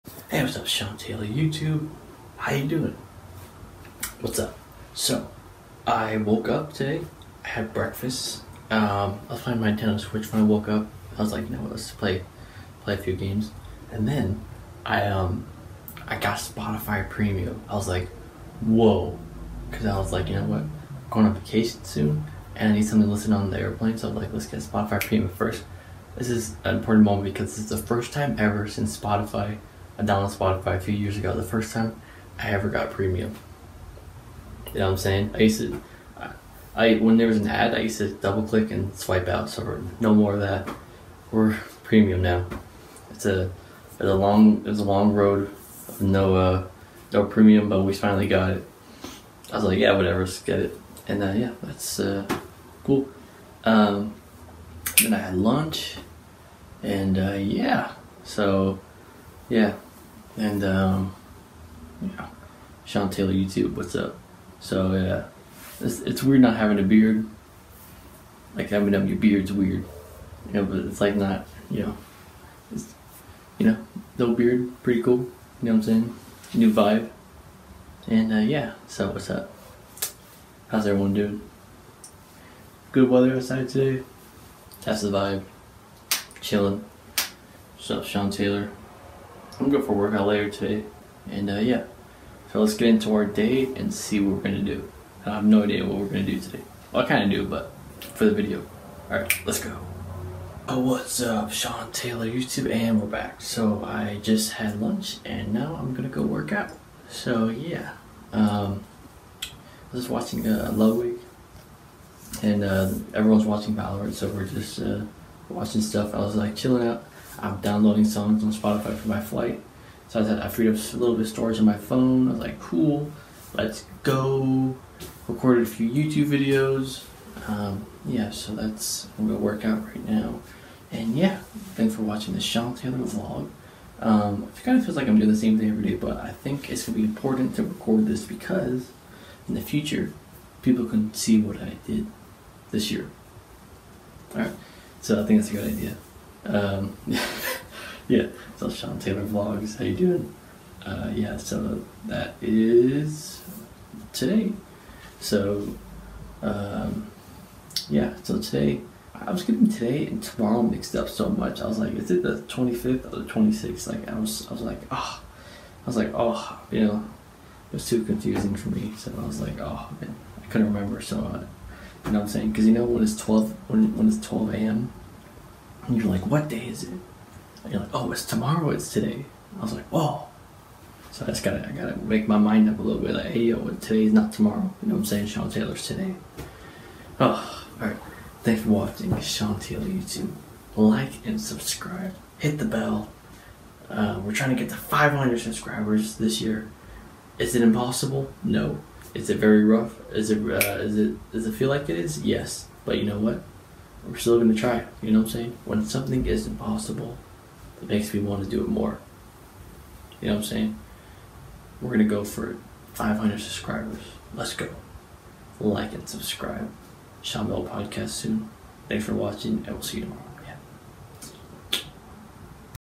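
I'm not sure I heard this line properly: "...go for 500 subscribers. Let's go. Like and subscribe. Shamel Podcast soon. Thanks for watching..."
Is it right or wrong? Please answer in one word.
right.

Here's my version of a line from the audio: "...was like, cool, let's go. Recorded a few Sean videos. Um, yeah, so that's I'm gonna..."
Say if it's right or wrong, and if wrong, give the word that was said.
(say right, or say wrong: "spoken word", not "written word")
wrong: "YouTube", not "Sean".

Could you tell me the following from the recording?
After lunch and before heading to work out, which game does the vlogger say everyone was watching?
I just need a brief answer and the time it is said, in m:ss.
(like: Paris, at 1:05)
Valorant, at 1:53.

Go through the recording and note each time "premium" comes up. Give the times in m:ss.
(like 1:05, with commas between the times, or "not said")
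0:17, 0:25, 0:32, 0:41, 0:47.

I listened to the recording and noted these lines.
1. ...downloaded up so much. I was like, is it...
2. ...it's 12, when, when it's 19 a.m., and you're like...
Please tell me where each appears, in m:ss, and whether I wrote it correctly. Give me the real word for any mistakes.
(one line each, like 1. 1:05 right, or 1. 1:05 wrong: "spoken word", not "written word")
1. 2:40 wrong: "mixed", not "downloaded"
2. 2:53 wrong: "12", not "19".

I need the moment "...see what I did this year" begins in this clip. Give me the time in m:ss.
2:21.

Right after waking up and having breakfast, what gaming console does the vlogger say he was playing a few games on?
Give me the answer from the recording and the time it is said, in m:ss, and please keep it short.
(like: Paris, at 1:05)
Nintendo Switch, at 0:09.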